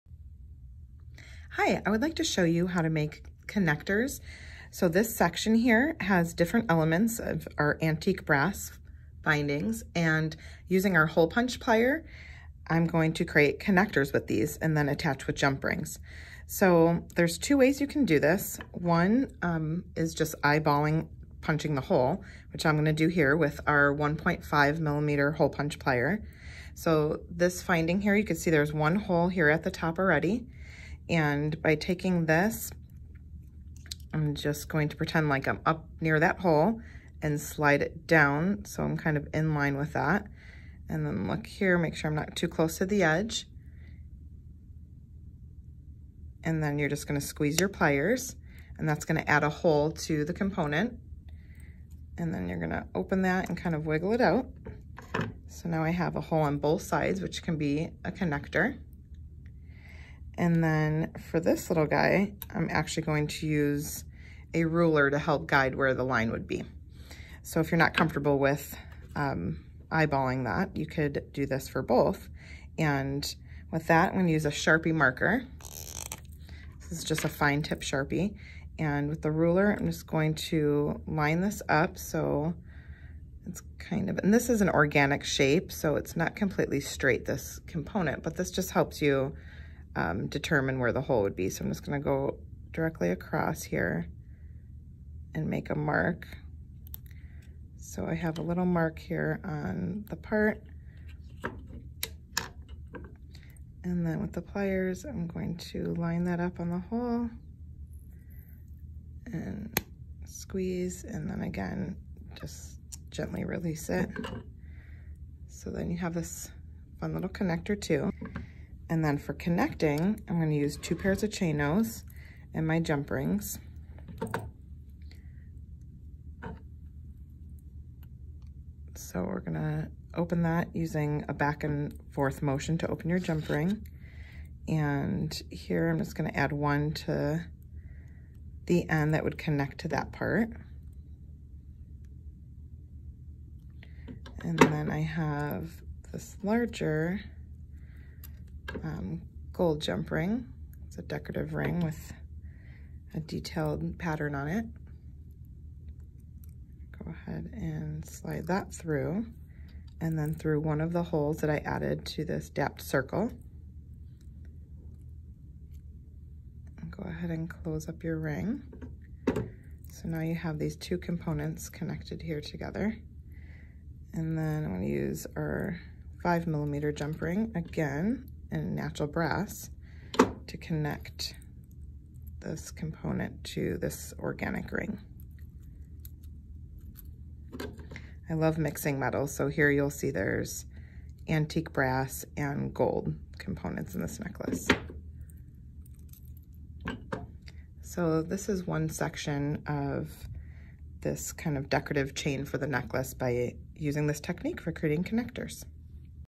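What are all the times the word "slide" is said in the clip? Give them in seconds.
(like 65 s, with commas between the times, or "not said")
37 s, 158 s.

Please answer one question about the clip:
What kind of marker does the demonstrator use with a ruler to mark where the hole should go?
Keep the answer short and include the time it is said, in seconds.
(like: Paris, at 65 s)
Fine tip Sharpie, at 77 s.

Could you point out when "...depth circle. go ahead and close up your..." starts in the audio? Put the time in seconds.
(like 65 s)
162 s.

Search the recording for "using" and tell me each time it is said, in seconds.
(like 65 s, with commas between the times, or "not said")
10 s, 130 s, 203 s.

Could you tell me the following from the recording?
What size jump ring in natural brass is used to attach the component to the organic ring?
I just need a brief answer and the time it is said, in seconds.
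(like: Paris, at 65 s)
5 millimeter, at 176 s.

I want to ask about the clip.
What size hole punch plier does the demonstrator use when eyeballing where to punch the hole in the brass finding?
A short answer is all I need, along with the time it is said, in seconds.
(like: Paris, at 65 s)
1.5 millimeter, at 23 s.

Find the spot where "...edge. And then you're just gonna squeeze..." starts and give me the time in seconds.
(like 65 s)
43 s.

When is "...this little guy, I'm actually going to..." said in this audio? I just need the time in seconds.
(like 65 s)
61 s.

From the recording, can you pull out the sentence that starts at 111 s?
And then again, just gently release it.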